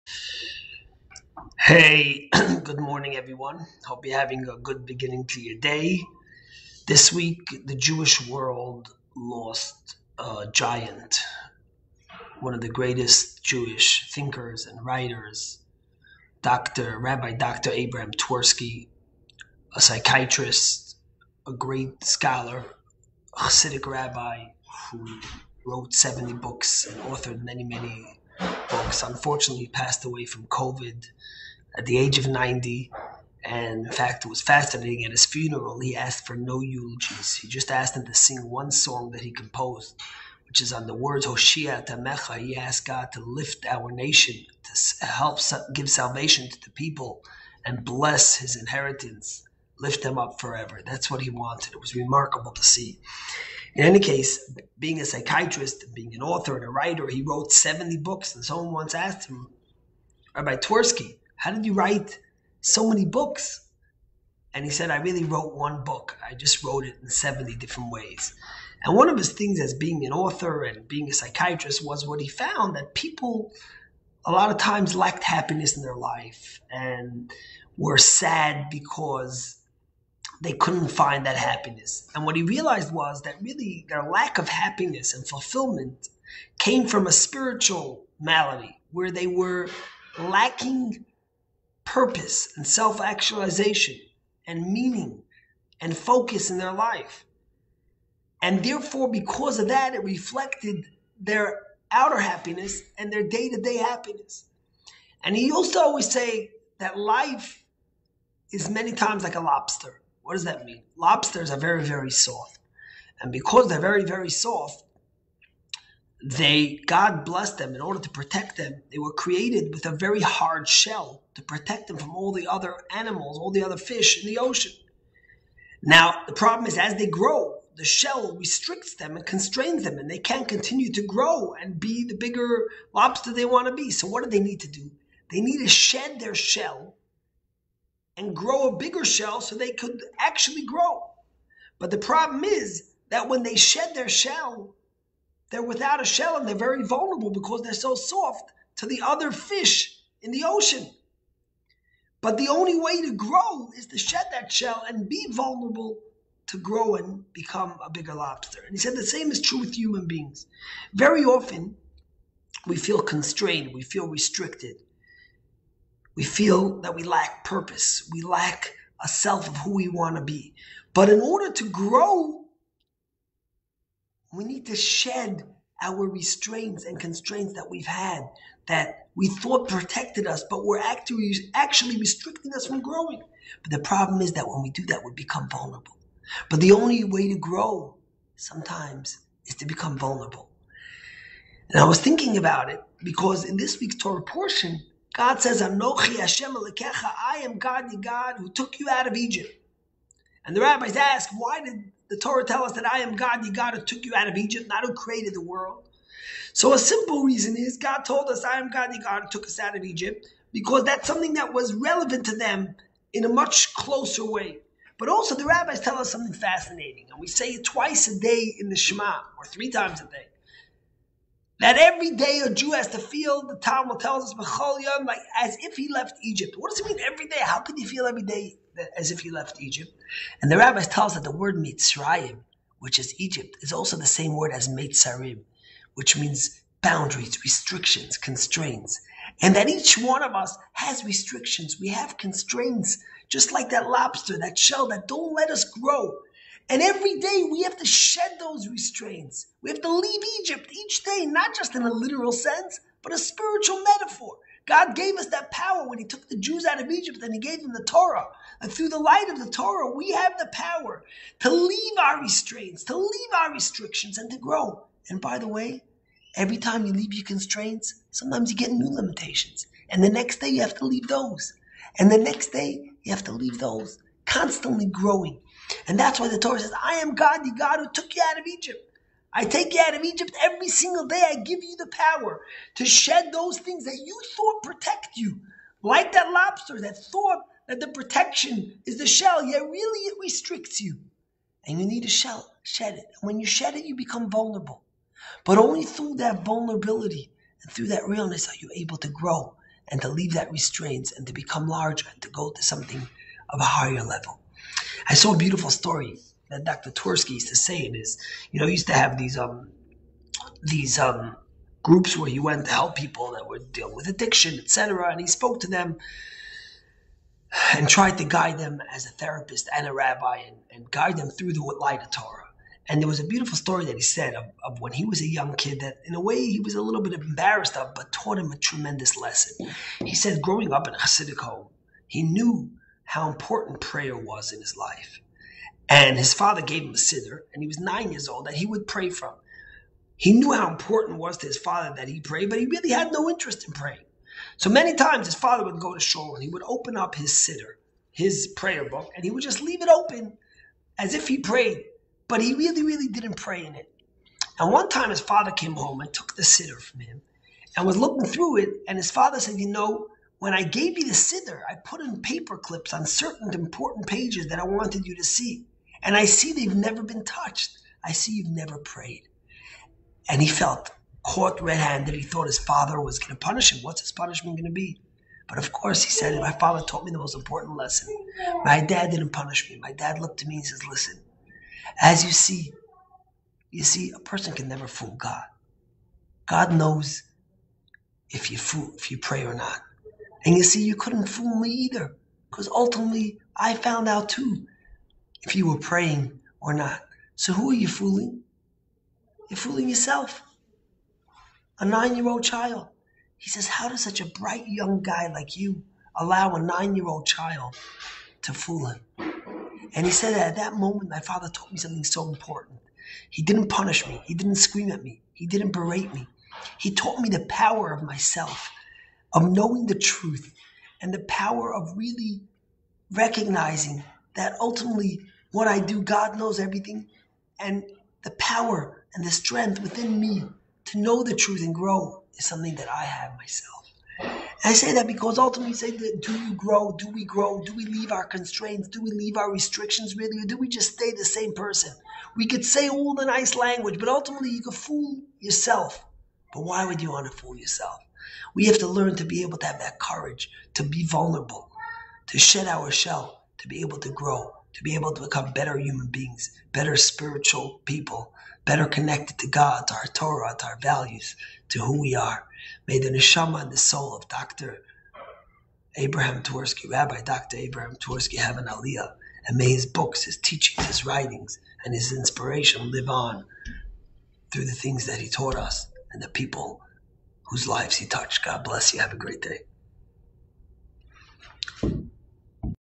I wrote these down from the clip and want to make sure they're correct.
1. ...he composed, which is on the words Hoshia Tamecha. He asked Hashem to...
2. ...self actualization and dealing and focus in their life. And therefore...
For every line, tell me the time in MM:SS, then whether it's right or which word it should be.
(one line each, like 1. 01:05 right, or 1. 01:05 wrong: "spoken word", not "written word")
1. 00:39 wrong: "God", not "Hashem"
2. 01:32 wrong: "meaning", not "dealing".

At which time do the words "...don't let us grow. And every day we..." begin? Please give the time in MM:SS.
04:05.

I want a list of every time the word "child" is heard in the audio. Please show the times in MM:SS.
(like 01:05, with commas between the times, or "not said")
06:42, 06:47.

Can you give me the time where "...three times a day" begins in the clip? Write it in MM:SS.
03:39.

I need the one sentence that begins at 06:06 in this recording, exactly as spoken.
And I see they've never been touched.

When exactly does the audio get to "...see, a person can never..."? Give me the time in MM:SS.
06:23.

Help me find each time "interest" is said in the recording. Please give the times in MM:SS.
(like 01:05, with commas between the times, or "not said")
05:43.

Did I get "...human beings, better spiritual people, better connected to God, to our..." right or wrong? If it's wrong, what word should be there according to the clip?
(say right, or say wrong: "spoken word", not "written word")
right.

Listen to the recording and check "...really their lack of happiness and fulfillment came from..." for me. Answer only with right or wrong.
right.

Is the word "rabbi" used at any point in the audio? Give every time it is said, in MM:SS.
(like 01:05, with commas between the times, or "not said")
00:16, 00:23, 01:00, 03:20, 03:35, 03:50, 05:19, 07:46.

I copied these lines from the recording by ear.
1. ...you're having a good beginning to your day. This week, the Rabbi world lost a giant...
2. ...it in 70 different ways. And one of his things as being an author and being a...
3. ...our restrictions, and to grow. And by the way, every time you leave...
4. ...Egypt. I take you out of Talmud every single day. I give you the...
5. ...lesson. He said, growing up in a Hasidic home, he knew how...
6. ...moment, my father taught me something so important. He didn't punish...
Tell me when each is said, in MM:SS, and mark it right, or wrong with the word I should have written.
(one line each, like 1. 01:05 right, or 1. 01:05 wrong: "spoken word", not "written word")
1. 00:04 wrong: "Jewish", not "Rabbi"
2. 01:06 right
3. 04:23 right
4. 04:38 wrong: "Egypt", not "Talmud"
5. 05:29 right
6. 06:50 right.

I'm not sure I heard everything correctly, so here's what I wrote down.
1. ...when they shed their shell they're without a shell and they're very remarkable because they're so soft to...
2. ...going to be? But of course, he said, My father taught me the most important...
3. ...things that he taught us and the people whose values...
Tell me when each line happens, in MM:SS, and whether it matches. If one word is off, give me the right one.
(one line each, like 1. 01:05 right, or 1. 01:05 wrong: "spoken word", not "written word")
1. 02:23 wrong: "vulnerable", not "remarkable"
2. 06:14 right
3. 07:54 wrong: "lives", not "values".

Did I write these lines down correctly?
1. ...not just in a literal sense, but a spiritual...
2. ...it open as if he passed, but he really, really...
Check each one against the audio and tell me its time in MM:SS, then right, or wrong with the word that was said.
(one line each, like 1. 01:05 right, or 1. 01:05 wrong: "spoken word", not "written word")
1. 04:11 right
2. 05:49 wrong: "prayed", not "passed".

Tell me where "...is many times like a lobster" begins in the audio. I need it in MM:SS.
01:48.